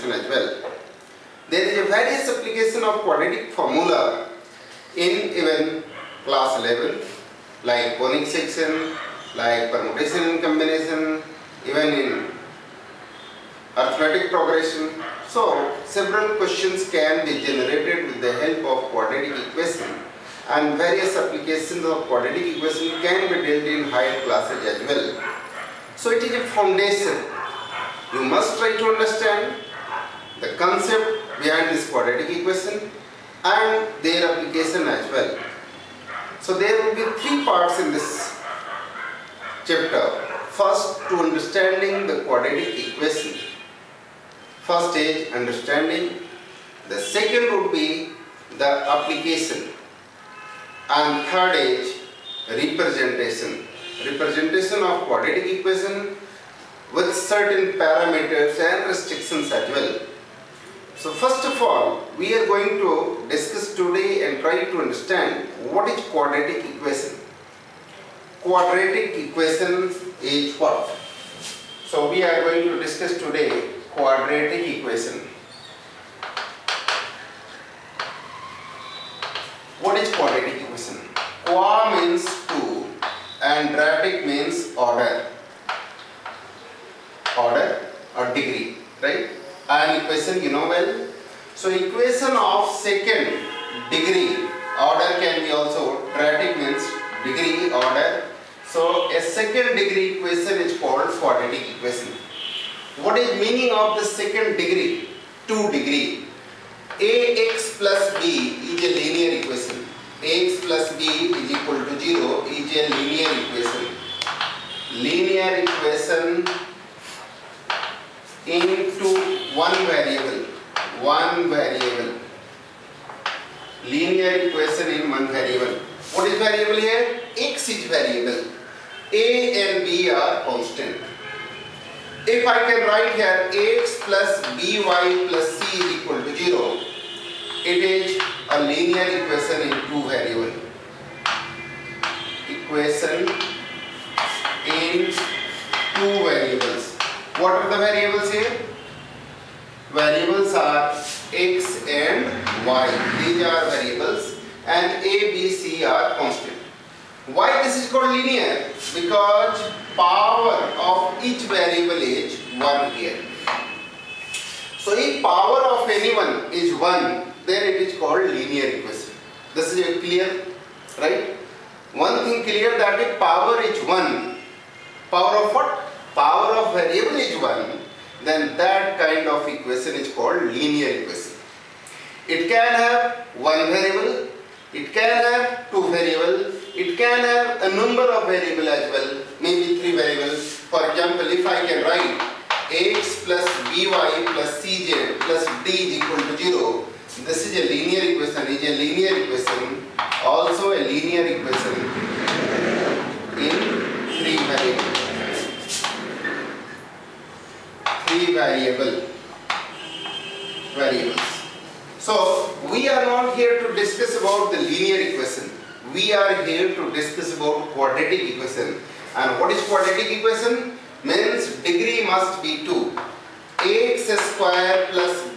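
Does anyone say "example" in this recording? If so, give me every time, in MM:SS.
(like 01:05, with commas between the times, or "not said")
03:10.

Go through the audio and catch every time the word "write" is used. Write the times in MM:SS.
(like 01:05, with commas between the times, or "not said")
02:12, 03:11.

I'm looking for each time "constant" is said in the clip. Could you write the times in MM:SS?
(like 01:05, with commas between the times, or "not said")
02:10, 02:36.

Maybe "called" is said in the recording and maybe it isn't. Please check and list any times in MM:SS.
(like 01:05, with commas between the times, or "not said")
01:40, 02:37, 02:47, 03:00.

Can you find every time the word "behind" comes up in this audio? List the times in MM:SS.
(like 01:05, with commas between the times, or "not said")
00:31.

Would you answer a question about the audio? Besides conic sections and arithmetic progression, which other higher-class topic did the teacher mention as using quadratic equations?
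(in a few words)
Permutation and combination.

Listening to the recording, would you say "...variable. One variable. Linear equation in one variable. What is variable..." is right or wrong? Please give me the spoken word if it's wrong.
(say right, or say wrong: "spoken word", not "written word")
right.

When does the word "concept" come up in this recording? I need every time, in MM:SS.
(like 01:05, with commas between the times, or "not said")
00:30.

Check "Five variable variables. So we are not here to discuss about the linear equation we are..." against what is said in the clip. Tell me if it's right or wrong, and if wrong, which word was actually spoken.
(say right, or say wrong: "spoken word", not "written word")
wrong: "Three", not "Five".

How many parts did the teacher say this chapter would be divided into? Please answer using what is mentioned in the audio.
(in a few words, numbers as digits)
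3.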